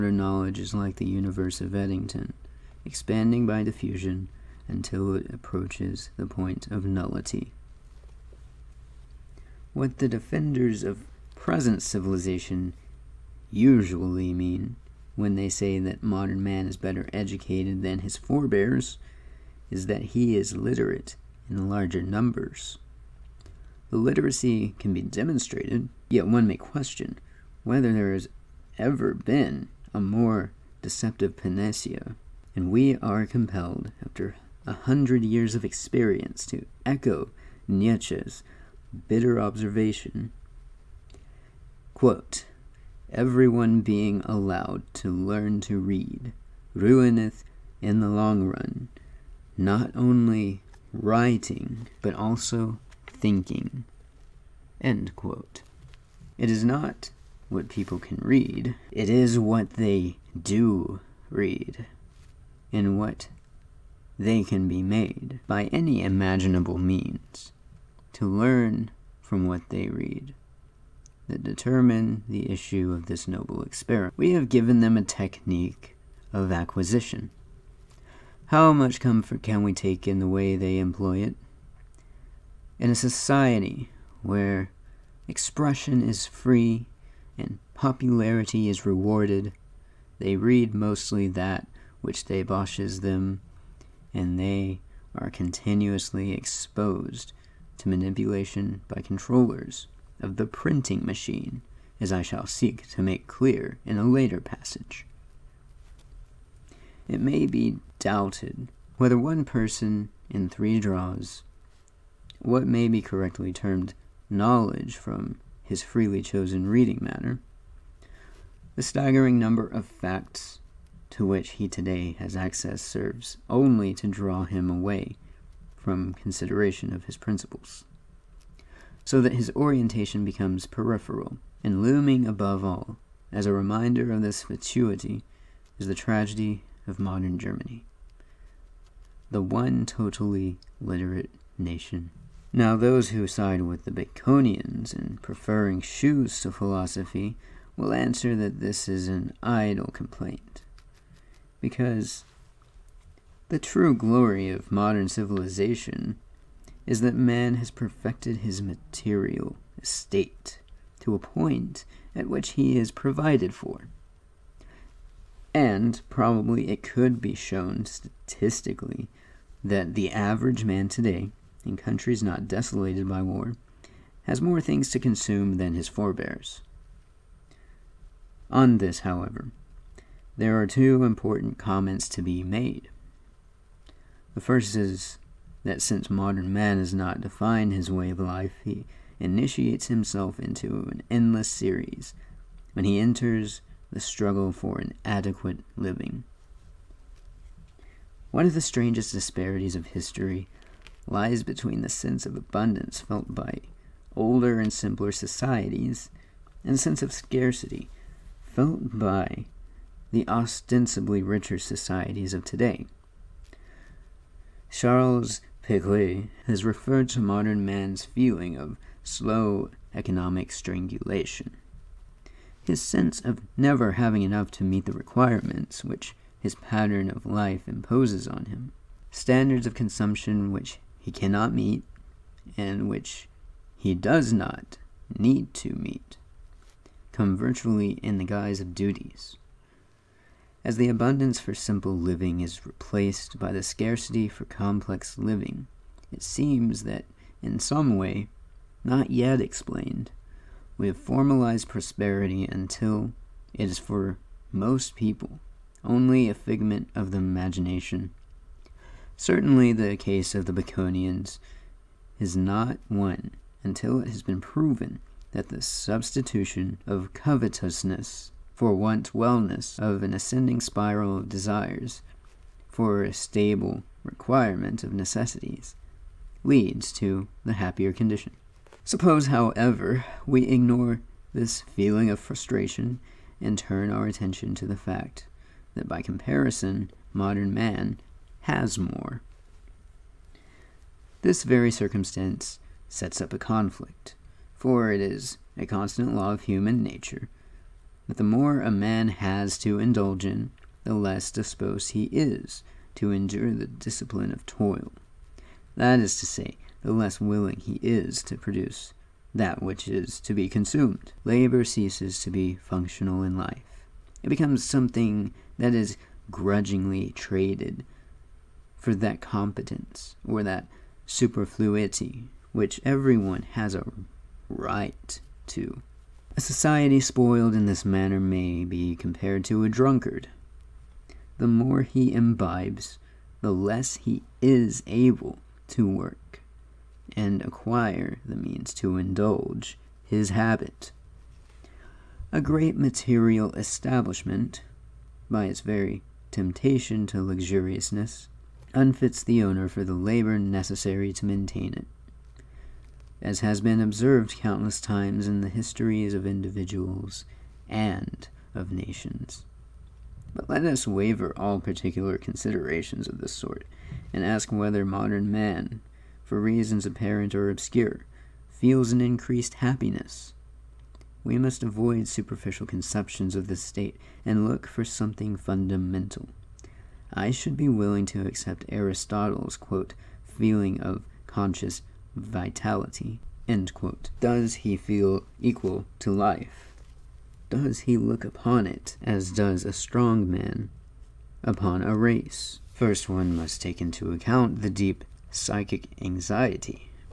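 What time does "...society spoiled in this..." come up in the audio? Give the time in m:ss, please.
5:26.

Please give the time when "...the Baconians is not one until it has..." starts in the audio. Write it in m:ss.
4:20.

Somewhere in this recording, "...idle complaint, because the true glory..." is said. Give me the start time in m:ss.
2:29.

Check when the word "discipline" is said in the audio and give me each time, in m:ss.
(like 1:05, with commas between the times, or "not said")
5:03.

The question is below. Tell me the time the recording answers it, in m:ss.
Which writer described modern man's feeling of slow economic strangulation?
3:34.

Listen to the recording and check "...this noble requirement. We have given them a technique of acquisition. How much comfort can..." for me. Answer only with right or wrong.
wrong.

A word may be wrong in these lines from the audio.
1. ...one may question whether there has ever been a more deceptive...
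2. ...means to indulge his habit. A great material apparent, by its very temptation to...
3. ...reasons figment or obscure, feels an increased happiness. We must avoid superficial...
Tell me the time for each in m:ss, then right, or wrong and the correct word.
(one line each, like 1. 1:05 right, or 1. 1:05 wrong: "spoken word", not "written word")
1. 0:26 right
2. 5:38 wrong: "establishment", not "apparent"
3. 6:06 wrong: "apparent", not "figment".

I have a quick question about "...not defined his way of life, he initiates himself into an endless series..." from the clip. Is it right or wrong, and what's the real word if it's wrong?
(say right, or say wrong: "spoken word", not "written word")
right.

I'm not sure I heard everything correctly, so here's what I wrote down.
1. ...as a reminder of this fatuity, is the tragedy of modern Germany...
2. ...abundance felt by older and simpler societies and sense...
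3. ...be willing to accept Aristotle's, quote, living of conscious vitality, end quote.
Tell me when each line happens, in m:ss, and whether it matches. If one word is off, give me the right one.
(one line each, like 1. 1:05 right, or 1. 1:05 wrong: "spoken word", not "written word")
1. 2:13 right
2. 3:22 right
3. 6:17 wrong: "feeling", not "living".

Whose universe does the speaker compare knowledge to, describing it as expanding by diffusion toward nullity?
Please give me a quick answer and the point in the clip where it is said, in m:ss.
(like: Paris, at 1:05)
Eddington, at 0:01.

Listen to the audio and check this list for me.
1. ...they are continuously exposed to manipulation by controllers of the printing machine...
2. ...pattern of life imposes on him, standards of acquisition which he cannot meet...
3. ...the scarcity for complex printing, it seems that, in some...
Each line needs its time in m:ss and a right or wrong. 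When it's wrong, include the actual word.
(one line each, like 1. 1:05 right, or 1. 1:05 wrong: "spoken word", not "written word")
1. 1:34 right
2. 3:46 wrong: "consumption", not "acquisition"
3. 4:03 wrong: "living", not "printing".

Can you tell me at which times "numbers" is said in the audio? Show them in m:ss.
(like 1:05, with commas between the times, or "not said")
0:22, 1:59.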